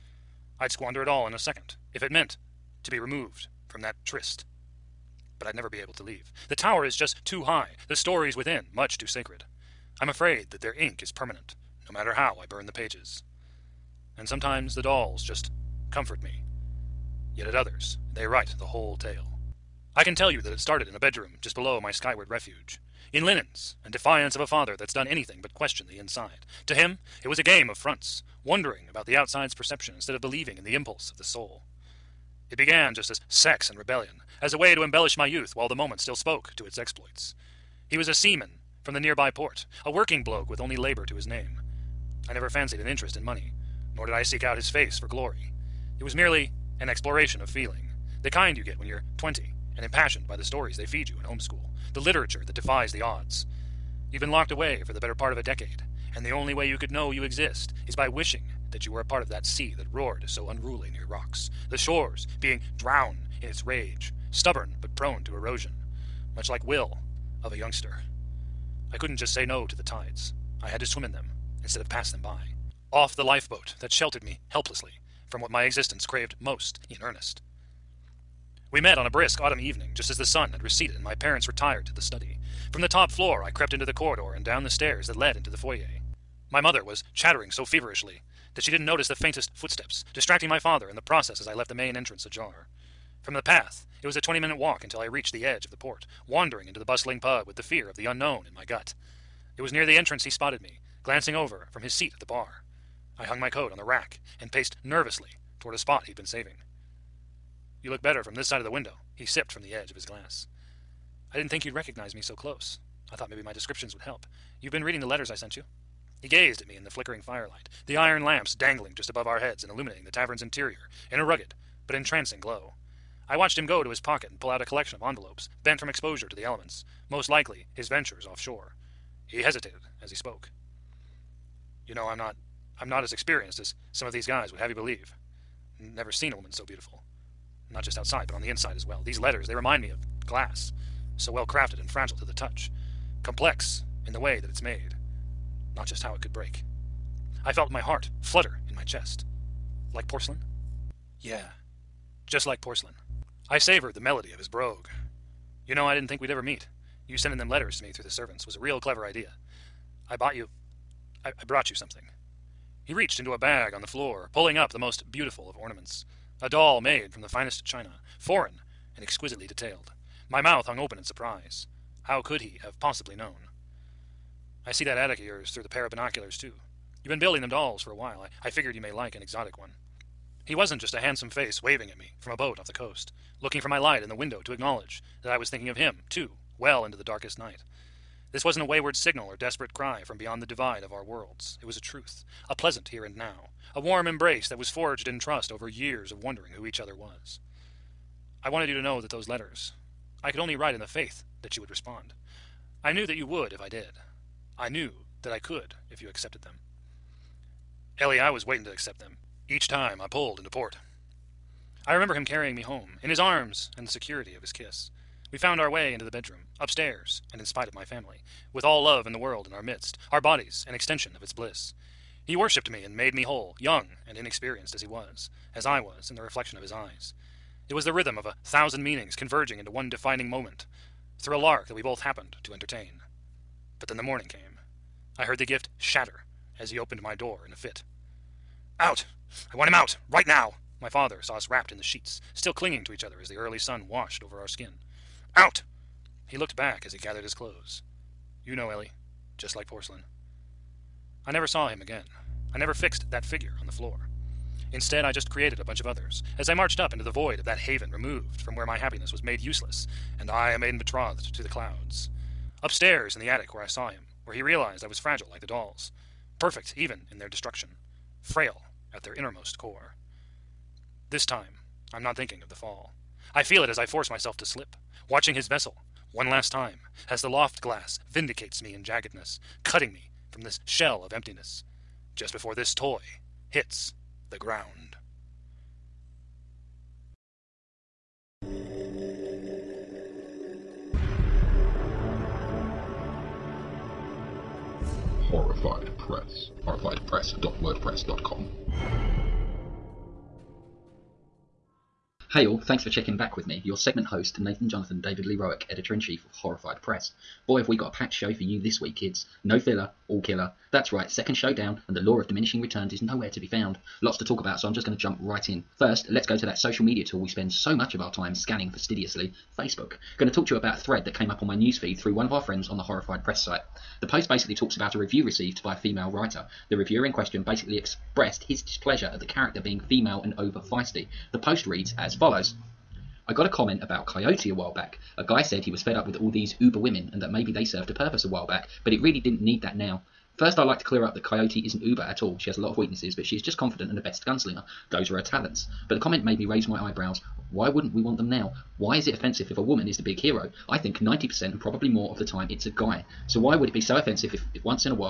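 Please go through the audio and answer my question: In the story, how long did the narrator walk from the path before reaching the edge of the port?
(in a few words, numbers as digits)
20 minutes.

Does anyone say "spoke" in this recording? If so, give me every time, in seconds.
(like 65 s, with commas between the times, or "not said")
36 s, 130 s.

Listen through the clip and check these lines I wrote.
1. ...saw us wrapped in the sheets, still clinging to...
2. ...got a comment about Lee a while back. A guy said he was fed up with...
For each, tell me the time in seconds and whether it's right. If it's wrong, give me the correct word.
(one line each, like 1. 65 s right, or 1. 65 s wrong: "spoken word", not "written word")
1. 241 s right
2. 333 s wrong: "Coyote", not "Lee".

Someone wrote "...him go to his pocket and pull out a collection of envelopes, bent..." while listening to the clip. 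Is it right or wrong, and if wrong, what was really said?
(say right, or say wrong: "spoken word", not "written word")
right.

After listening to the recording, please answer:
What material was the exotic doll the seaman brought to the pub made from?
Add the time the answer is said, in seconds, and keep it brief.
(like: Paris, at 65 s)
china, at 167 s.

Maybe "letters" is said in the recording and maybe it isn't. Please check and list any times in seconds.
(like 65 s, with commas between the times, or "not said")
115 s, 139 s, 157 s, 199 s.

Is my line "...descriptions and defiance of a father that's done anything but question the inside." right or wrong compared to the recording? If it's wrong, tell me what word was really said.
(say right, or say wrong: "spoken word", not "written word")
wrong: "linens", not "descriptions".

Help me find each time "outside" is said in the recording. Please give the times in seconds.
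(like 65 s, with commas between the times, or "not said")
29 s, 137 s.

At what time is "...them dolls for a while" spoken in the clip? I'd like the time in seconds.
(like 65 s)
177 s.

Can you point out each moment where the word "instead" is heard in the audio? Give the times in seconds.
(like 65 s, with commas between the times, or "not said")
29 s, 71 s, 254 s.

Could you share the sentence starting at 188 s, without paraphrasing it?
This wasn't a wayward signal or desperate cry from beyond the divide of our worlds.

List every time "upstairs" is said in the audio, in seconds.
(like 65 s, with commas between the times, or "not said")
216 s, 262 s.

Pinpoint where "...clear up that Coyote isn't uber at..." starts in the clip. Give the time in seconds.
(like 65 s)
340 s.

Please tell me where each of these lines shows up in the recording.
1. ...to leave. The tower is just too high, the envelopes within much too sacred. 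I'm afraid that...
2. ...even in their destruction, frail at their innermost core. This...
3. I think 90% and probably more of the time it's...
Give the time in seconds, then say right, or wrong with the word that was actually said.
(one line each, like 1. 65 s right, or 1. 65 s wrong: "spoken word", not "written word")
1. 5 s wrong: "stories", not "envelopes"
2. 266 s right
3. 350 s right.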